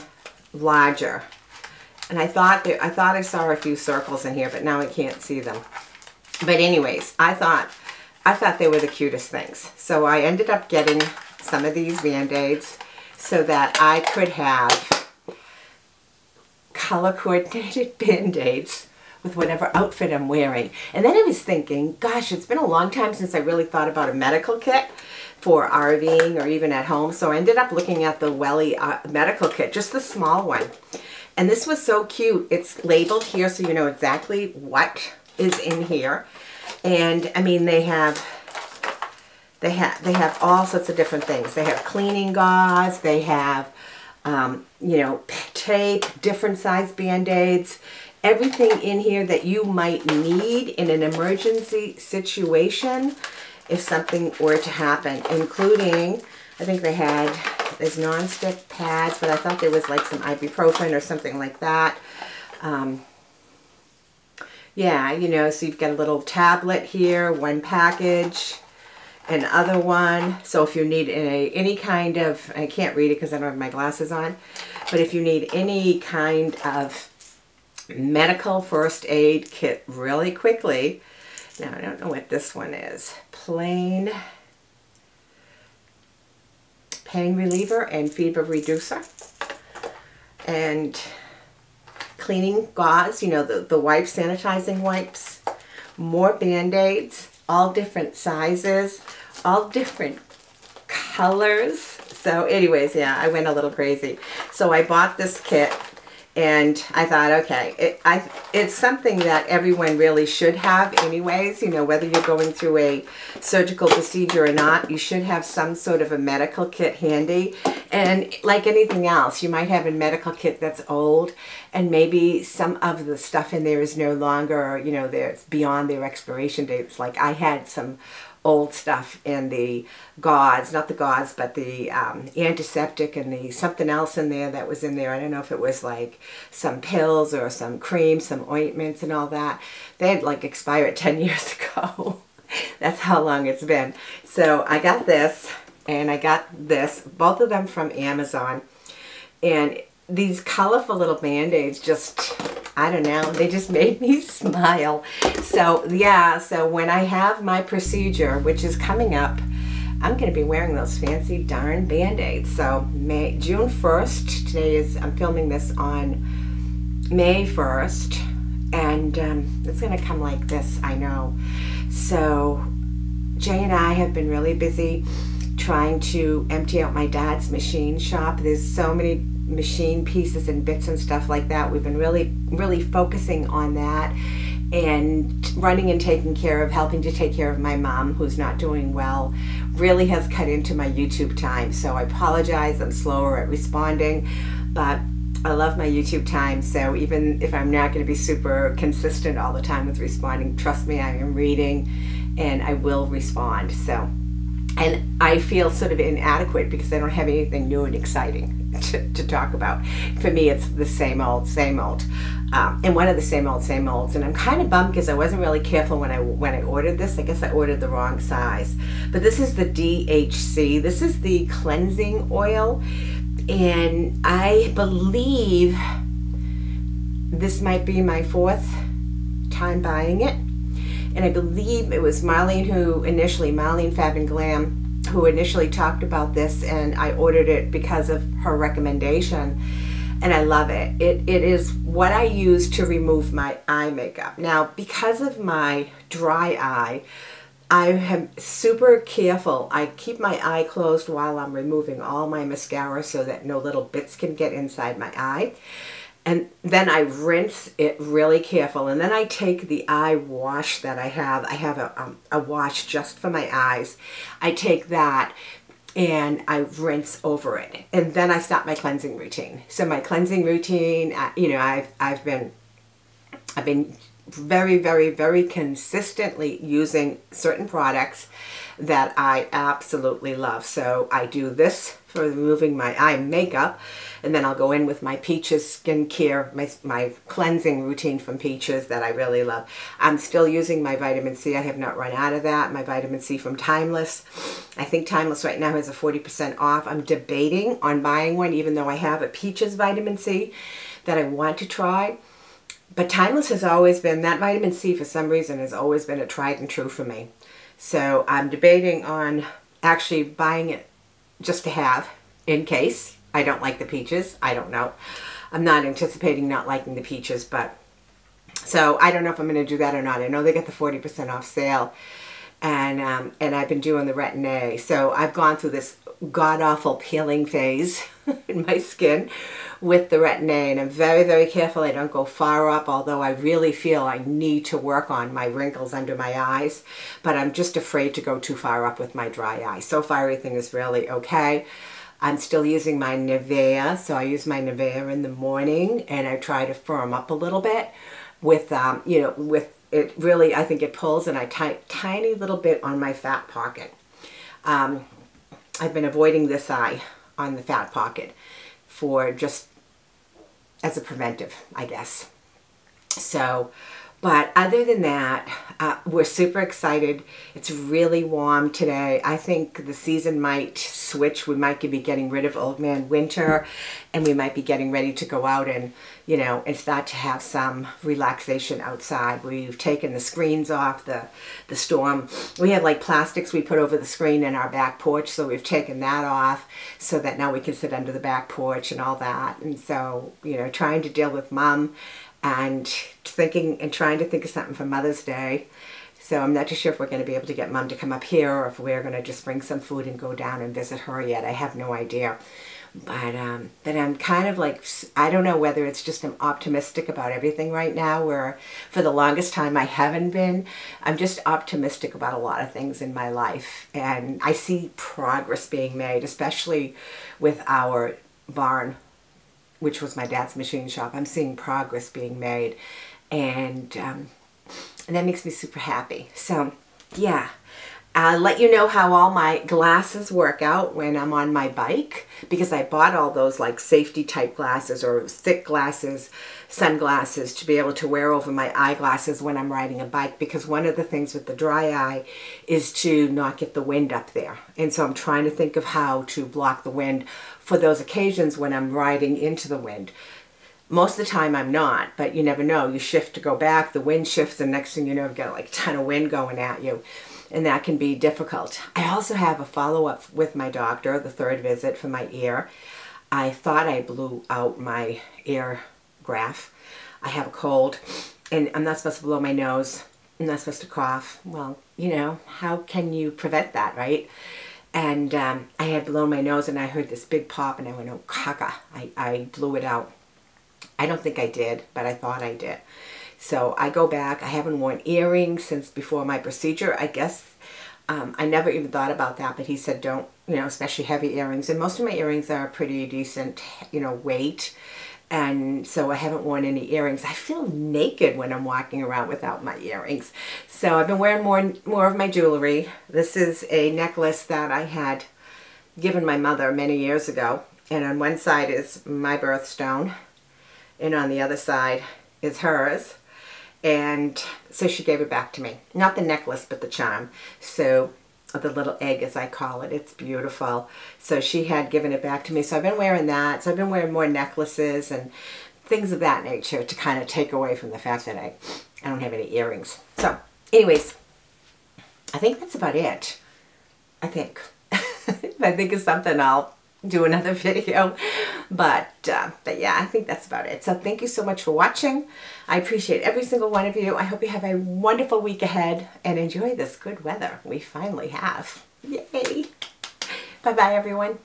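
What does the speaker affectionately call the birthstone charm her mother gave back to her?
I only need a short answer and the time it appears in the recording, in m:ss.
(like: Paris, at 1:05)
the little egg, at 8:38.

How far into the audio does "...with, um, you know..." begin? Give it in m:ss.
5:48.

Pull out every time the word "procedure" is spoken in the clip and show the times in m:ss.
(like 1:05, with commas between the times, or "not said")
1:53, 2:37, 8:06.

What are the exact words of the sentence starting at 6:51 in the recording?
I'm just optimistic about a lot of things in my life.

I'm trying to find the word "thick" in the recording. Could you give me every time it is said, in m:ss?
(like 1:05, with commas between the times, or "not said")
7:15.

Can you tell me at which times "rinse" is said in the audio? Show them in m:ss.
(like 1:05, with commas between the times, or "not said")
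4:16, 4:26.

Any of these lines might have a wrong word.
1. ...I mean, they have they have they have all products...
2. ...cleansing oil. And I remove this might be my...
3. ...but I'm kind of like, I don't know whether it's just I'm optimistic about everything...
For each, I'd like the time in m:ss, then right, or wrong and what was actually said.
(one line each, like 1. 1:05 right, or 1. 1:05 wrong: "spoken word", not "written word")
1. 0:37 wrong: "sorts", not "products"
2. 3:41 wrong: "believe", not "remove"
3. 6:43 right.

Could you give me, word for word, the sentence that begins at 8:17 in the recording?
I feel naked when I'm walking around without my earrings.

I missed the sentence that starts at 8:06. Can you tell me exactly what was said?
I guess um, I never even thought about that, but he said don't, you know, especially heavy earrings.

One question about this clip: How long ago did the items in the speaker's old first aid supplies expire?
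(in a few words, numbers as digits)
10 years ago.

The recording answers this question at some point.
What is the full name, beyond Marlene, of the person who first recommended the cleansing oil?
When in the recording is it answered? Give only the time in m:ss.
3:53.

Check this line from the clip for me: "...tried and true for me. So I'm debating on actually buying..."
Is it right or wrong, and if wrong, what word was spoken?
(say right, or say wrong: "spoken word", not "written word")
right.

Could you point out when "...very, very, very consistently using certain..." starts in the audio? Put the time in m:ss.
4:34.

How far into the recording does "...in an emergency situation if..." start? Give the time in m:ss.
0:50.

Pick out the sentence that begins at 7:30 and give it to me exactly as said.
Most of the time I'm not, but you never know.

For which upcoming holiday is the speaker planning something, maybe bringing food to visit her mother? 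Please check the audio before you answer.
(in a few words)
Mother's Day.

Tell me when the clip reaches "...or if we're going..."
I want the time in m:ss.
6:38.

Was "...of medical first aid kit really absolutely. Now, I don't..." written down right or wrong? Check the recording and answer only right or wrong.
wrong.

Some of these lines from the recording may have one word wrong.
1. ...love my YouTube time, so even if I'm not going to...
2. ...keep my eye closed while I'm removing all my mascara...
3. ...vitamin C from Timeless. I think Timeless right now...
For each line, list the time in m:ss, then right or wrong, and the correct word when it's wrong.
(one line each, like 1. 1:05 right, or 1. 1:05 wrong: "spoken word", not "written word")
1. 3:15 right
2. 4:09 right
3. 4:52 right.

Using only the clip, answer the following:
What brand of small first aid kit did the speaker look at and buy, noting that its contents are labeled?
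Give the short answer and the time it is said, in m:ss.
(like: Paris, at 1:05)
Welly, at 0:28.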